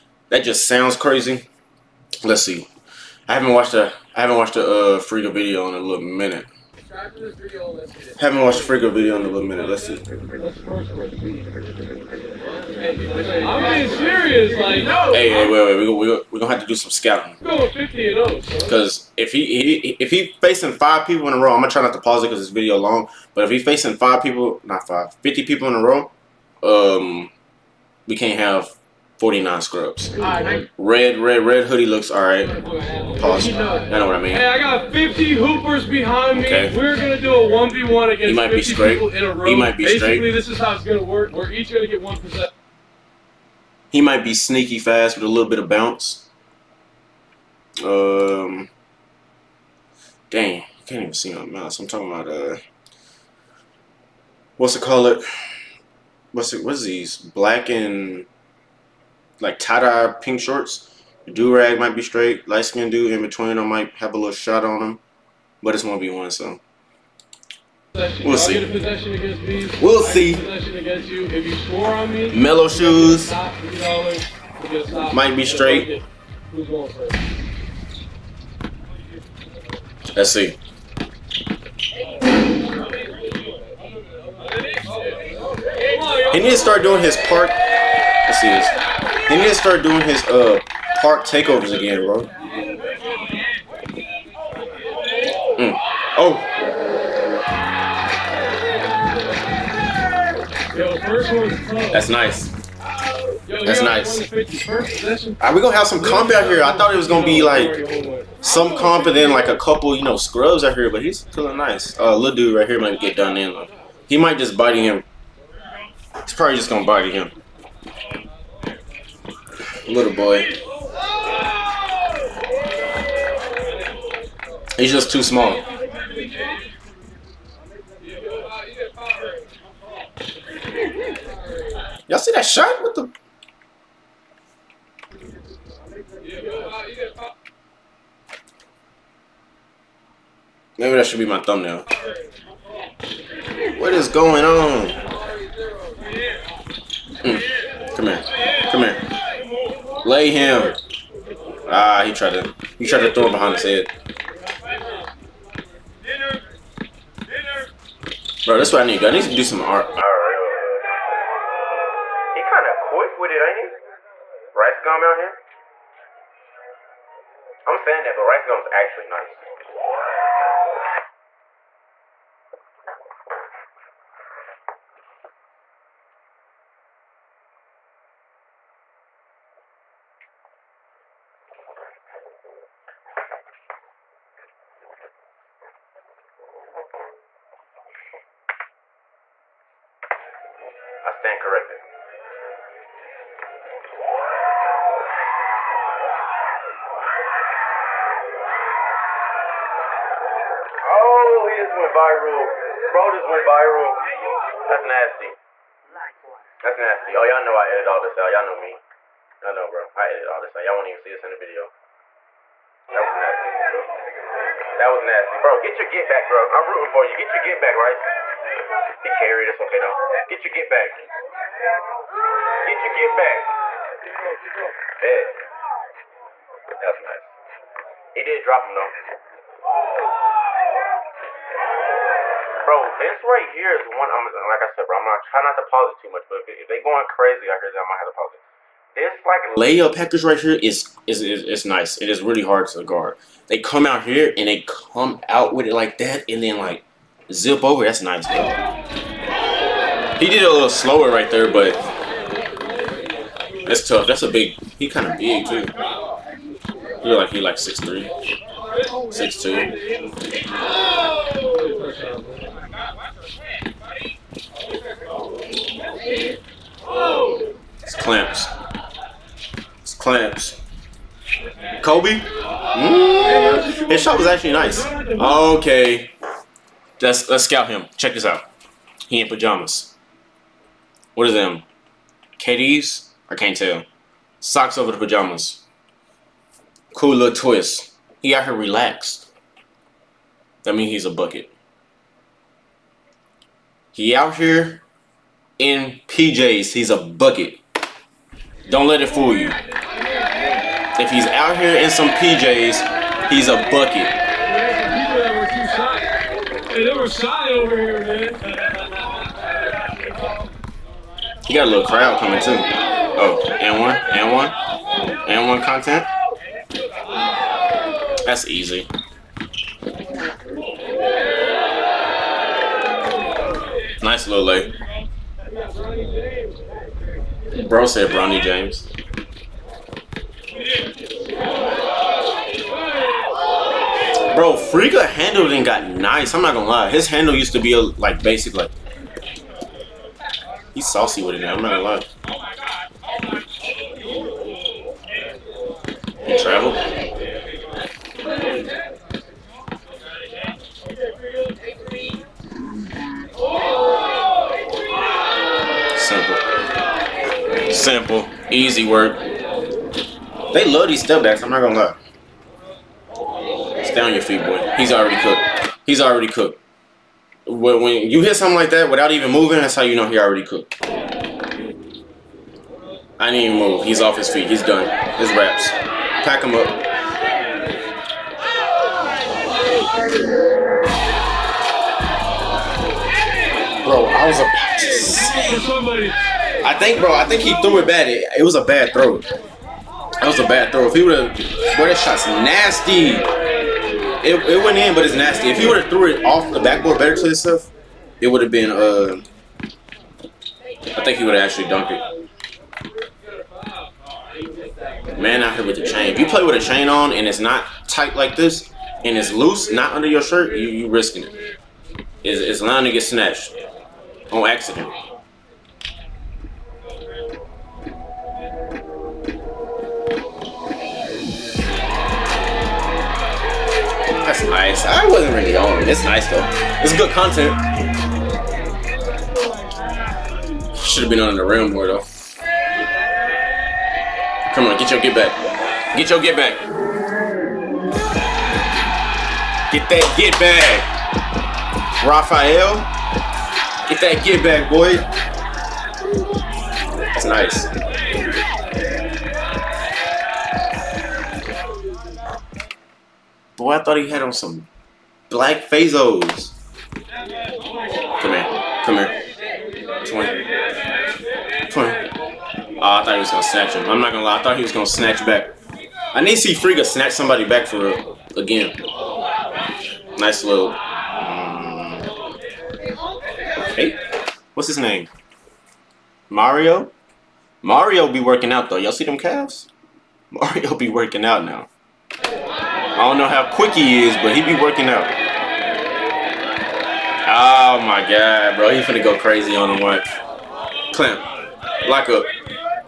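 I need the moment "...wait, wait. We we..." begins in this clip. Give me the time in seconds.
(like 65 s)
15 s.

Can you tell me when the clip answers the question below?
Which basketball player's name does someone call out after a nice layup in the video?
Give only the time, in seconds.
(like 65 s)
328 s.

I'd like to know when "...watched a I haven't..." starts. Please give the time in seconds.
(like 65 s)
3 s.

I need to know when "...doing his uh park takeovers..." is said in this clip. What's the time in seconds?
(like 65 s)
89 s.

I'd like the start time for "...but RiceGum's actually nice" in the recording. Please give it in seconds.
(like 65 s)
168 s.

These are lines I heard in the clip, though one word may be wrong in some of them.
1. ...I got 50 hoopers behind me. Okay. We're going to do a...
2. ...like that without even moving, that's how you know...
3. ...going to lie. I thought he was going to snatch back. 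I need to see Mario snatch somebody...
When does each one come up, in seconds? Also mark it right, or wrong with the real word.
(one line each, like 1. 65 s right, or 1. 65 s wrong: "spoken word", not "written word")
1. 34 s right
2. 368 s right
3. 464 s wrong: "Friga", not "Mario".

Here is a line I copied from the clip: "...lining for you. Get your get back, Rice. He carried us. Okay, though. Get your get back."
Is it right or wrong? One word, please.
wrong.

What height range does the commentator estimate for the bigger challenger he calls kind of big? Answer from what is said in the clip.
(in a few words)
6'2" to 6'3".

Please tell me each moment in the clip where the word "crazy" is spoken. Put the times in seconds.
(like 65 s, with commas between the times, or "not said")
0 s, 237 s, 489 s.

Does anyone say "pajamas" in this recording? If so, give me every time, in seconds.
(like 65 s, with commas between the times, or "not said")
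279 s, 284 s.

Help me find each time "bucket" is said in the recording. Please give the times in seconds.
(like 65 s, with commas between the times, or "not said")
291 s, 296 s, 303 s.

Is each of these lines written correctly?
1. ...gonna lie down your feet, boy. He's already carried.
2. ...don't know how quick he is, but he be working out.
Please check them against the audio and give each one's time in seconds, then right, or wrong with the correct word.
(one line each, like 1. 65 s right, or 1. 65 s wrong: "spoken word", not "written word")
1. 361 s wrong: "cooked", not "carried"
2. 483 s right.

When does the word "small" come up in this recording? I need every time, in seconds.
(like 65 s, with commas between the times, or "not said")
125 s.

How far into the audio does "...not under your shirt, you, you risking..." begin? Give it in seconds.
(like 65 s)
409 s.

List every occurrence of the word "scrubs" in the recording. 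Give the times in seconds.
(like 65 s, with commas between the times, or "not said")
29 s, 110 s.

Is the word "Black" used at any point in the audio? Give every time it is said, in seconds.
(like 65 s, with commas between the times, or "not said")
57 s, 455 s.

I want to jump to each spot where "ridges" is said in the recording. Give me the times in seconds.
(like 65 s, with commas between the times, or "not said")
not said.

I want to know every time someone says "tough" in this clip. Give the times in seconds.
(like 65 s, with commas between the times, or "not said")
253 s.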